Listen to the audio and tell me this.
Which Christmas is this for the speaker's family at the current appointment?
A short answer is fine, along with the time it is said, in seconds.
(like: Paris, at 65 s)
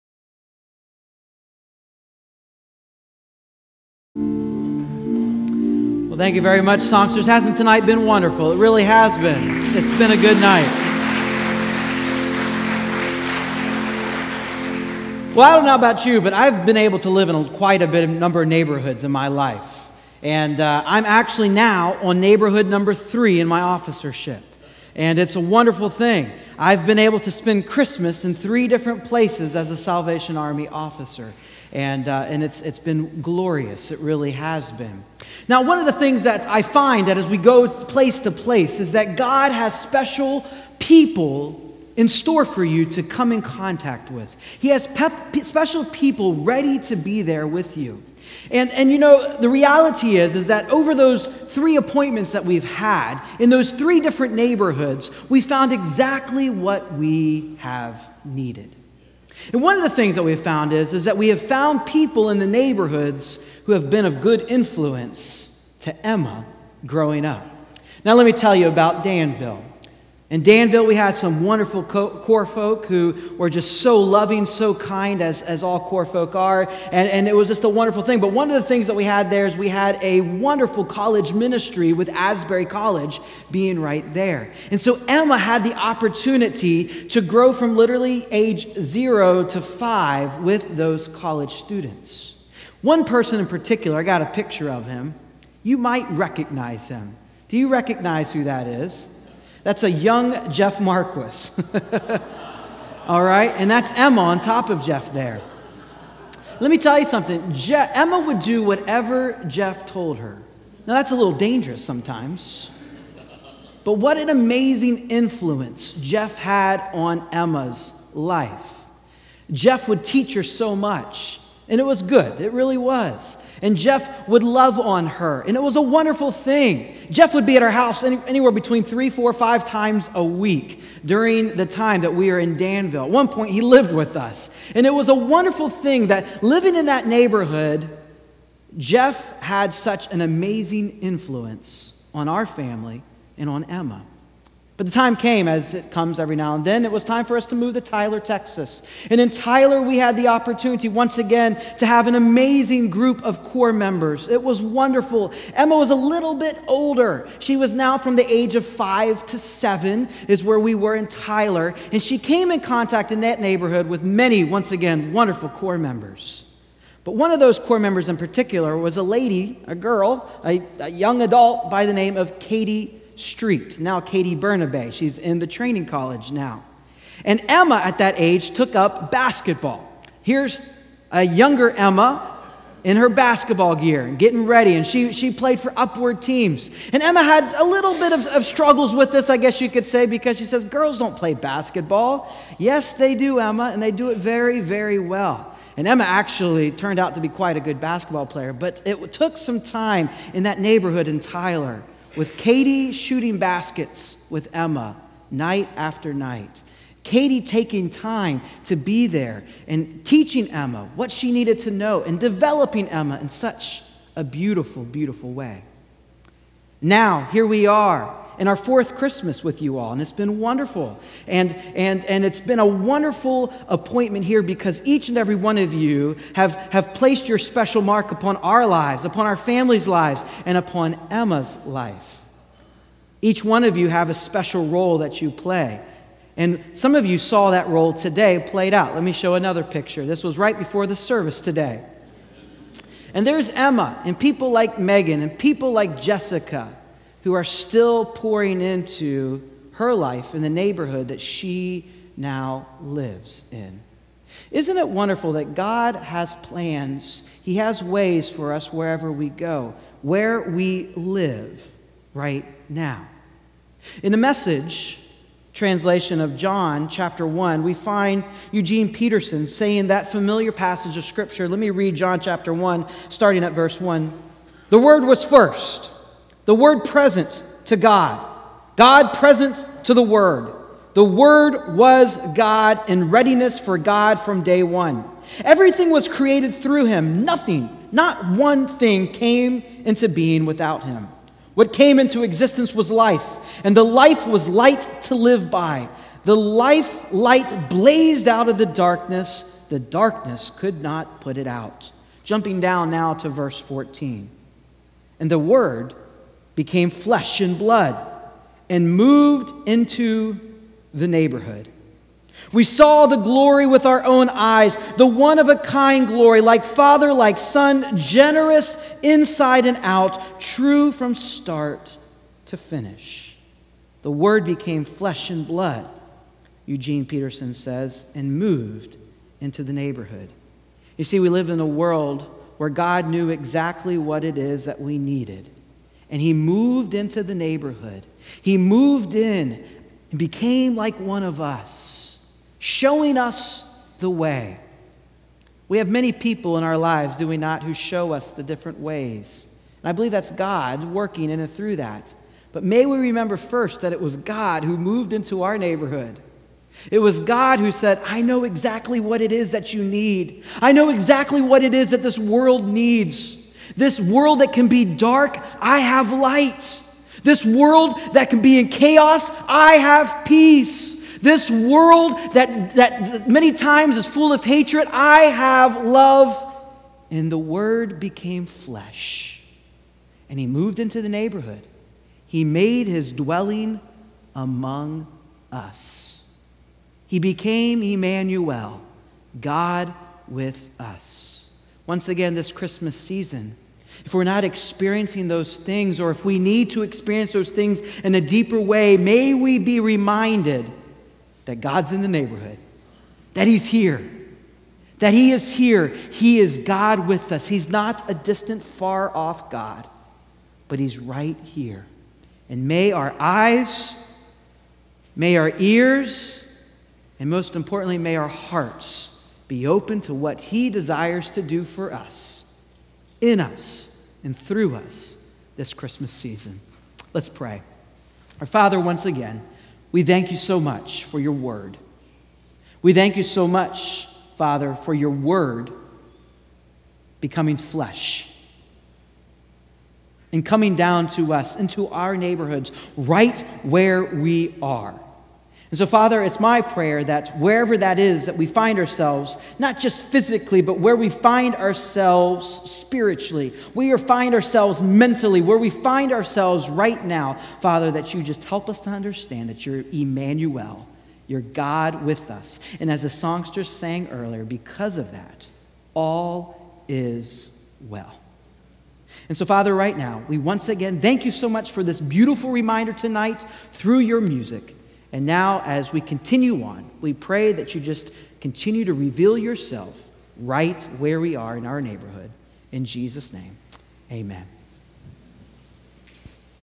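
Fourth, at 218 s.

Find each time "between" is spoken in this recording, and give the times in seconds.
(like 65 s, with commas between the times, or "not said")
128 s.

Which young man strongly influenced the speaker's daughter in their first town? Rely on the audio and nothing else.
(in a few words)
Jeff Marquis.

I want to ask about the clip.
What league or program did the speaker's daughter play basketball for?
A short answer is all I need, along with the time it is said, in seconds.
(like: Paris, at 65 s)
Upward, at 185 s.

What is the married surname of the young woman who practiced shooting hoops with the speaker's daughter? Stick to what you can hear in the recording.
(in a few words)
Burnaby.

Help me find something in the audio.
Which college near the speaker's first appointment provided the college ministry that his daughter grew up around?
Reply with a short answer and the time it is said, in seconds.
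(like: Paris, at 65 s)
Asbury College, at 82 s.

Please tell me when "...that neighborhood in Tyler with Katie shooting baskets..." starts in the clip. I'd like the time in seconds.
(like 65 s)
200 s.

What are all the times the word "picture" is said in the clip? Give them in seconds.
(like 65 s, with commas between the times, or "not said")
94 s, 239 s.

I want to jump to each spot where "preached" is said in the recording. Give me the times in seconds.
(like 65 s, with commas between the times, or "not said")
not said.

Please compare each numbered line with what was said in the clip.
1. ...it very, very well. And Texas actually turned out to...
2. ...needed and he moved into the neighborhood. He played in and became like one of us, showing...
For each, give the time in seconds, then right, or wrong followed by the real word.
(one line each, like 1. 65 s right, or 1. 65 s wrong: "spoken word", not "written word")
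1. 194 s wrong: "Emma", not "Texas"
2. 334 s wrong: "moved", not "played".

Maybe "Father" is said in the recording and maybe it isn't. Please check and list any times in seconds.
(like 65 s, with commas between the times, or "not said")
316 s, 428 s, 434 s, 445 s, 457 s, 469 s.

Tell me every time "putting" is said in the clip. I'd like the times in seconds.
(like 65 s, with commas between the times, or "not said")
not said.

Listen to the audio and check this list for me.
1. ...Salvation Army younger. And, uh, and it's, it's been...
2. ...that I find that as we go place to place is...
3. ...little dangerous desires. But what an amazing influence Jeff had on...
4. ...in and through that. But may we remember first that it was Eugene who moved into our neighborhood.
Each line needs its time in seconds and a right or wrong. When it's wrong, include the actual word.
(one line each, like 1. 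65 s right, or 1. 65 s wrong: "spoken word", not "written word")
1. 29 s wrong: "officer", not "younger"
2. 36 s right
3. 111 s wrong: "sometimes", not "desires"
4. 351 s wrong: "God", not "Eugene".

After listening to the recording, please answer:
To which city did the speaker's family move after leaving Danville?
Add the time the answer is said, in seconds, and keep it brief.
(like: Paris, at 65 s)
Tyler, Texas, at 147 s.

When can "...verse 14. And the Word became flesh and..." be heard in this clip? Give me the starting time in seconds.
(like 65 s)
303 s.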